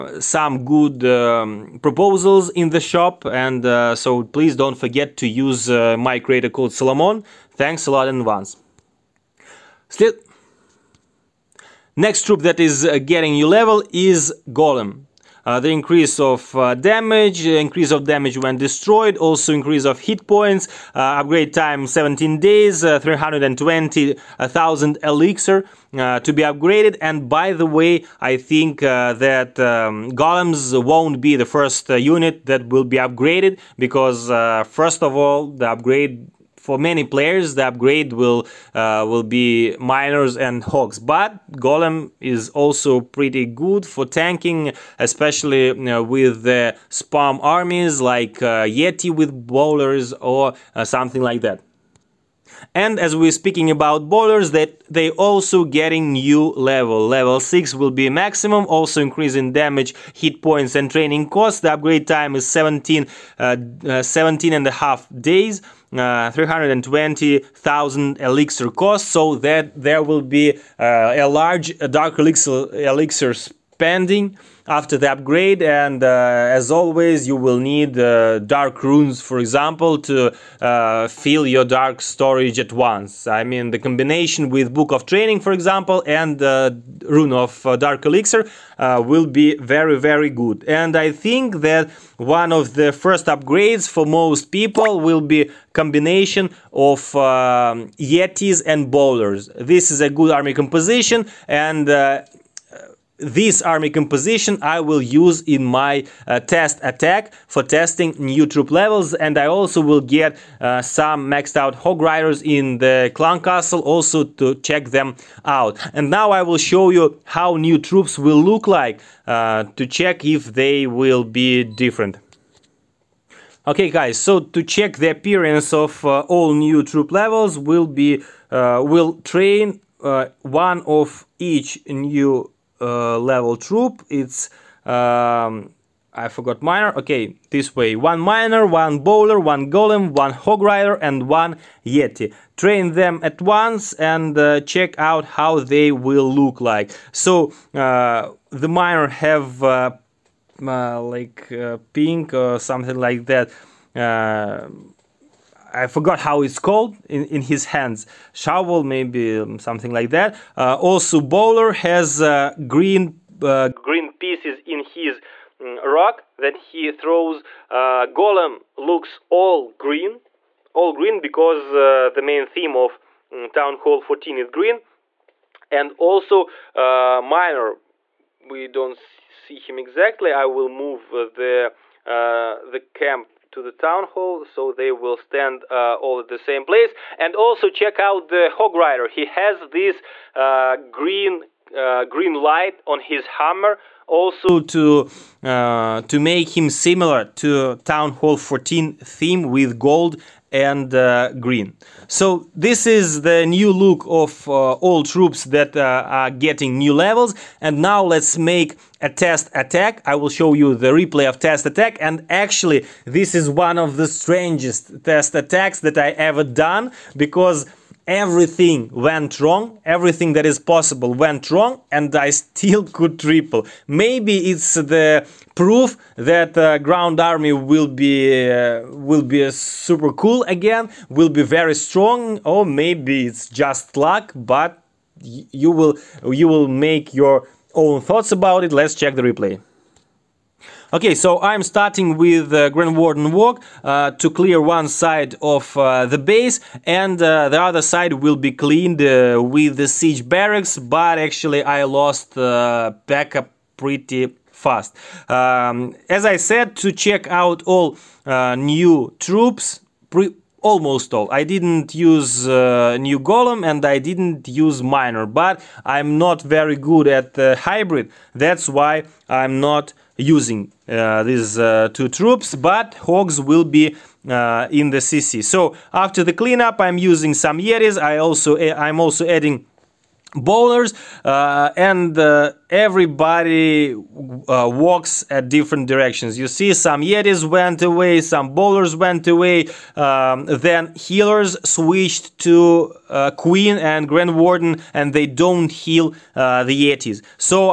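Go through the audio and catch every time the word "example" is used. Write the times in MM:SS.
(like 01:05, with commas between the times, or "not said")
01:19, 01:25.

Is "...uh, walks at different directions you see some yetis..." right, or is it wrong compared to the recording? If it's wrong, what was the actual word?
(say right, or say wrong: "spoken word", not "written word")
right.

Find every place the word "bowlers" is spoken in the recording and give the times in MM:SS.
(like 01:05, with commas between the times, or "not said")
00:49, 00:54, 01:38, 02:18, 02:41, 04:40, 04:48.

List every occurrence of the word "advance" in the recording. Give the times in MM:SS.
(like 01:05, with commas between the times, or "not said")
00:08.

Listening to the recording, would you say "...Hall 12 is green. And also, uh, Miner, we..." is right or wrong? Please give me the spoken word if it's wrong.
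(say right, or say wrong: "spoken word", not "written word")
wrong: "14", not "12".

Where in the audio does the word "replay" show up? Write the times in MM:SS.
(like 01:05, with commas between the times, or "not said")
03:30, 03:59.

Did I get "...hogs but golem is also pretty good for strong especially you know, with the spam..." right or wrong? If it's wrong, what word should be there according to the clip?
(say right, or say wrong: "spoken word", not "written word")
wrong: "tanking", not "strong".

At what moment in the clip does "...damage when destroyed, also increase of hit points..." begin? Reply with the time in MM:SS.
00:18.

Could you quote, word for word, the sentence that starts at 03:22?
So this is the new look of uh, all troops that uh, are getting new levels.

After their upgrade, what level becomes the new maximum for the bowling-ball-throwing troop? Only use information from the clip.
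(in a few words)
Level 6.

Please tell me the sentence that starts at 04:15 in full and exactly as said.
Um, as I said, to check out all uh, new troops, almost all.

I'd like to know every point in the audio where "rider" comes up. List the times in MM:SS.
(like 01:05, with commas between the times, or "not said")
01:52, 02:20, 03:08.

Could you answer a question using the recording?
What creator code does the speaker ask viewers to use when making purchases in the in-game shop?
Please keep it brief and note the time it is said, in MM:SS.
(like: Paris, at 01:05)
Salomon, at 00:06.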